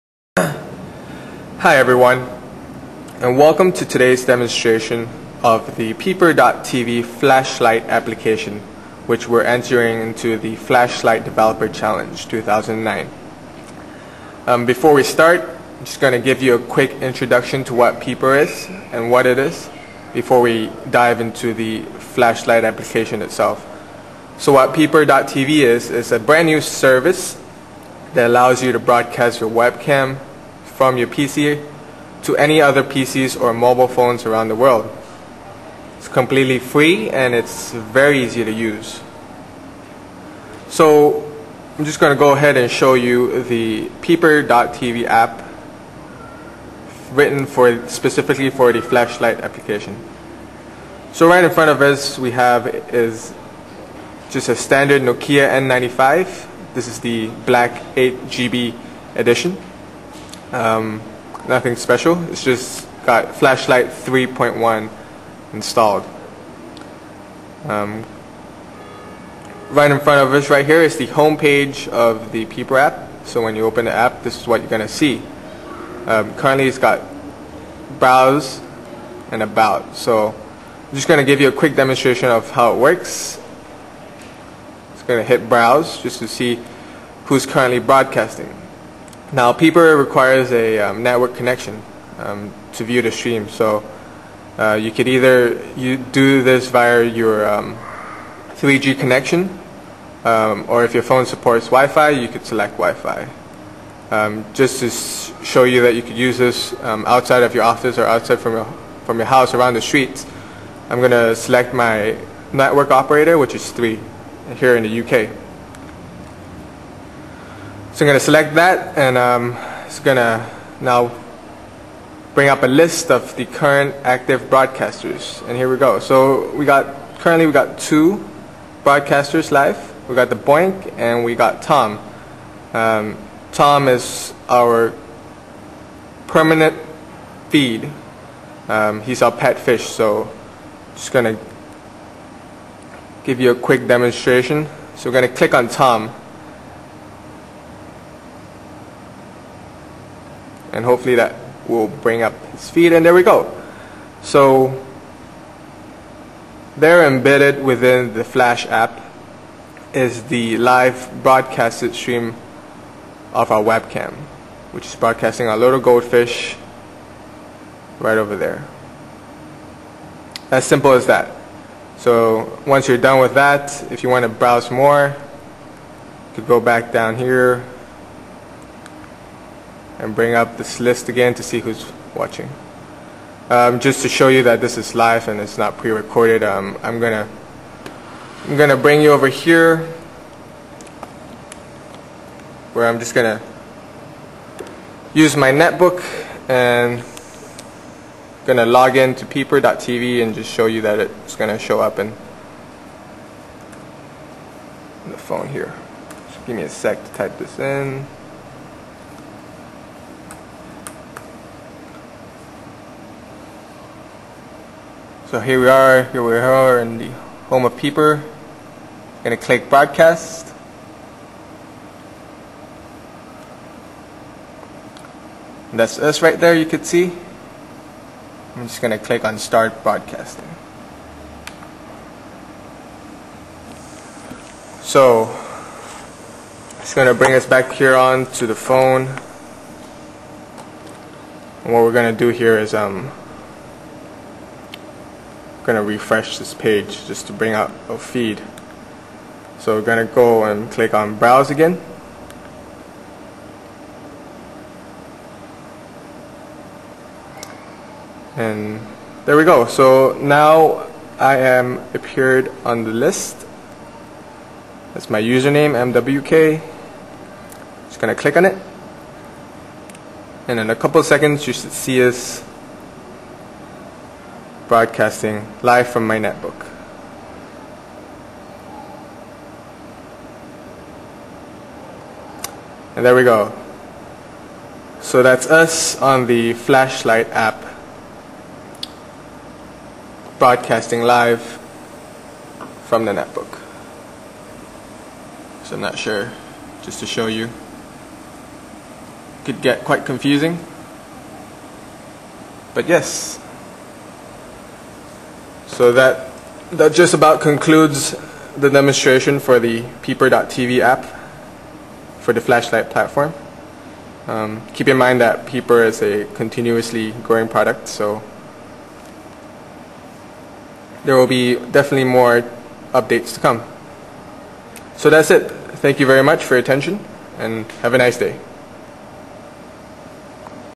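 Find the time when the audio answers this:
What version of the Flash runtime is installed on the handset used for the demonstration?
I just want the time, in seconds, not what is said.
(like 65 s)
63 s.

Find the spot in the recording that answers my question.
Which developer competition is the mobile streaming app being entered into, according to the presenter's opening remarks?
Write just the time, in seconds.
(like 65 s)
10 s.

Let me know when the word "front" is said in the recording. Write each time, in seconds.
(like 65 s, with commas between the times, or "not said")
51 s, 70 s.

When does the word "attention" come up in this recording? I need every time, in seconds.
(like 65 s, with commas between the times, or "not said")
326 s.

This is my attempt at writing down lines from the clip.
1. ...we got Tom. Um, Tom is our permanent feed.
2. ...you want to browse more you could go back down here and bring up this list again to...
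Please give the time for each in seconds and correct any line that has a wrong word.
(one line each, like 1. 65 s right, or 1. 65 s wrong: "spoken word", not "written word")
1. 131 s right
2. 174 s right.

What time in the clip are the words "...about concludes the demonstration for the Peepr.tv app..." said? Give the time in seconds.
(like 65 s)
307 s.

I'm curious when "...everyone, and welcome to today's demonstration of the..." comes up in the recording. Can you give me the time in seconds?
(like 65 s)
1 s.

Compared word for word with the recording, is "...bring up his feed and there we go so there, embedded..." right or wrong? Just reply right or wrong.
right.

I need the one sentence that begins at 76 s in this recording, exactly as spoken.
Um, currently it's got browse and about.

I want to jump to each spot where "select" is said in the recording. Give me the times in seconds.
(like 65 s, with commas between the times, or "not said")
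102 s, 111 s, 118 s.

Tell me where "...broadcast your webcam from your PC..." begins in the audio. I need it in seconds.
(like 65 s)
28 s.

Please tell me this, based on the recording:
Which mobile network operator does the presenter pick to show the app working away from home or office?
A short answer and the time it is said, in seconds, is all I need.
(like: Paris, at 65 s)
3, at 113 s.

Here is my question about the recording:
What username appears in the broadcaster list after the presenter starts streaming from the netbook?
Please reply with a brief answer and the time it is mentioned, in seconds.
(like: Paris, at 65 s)
MWK, at 265 s.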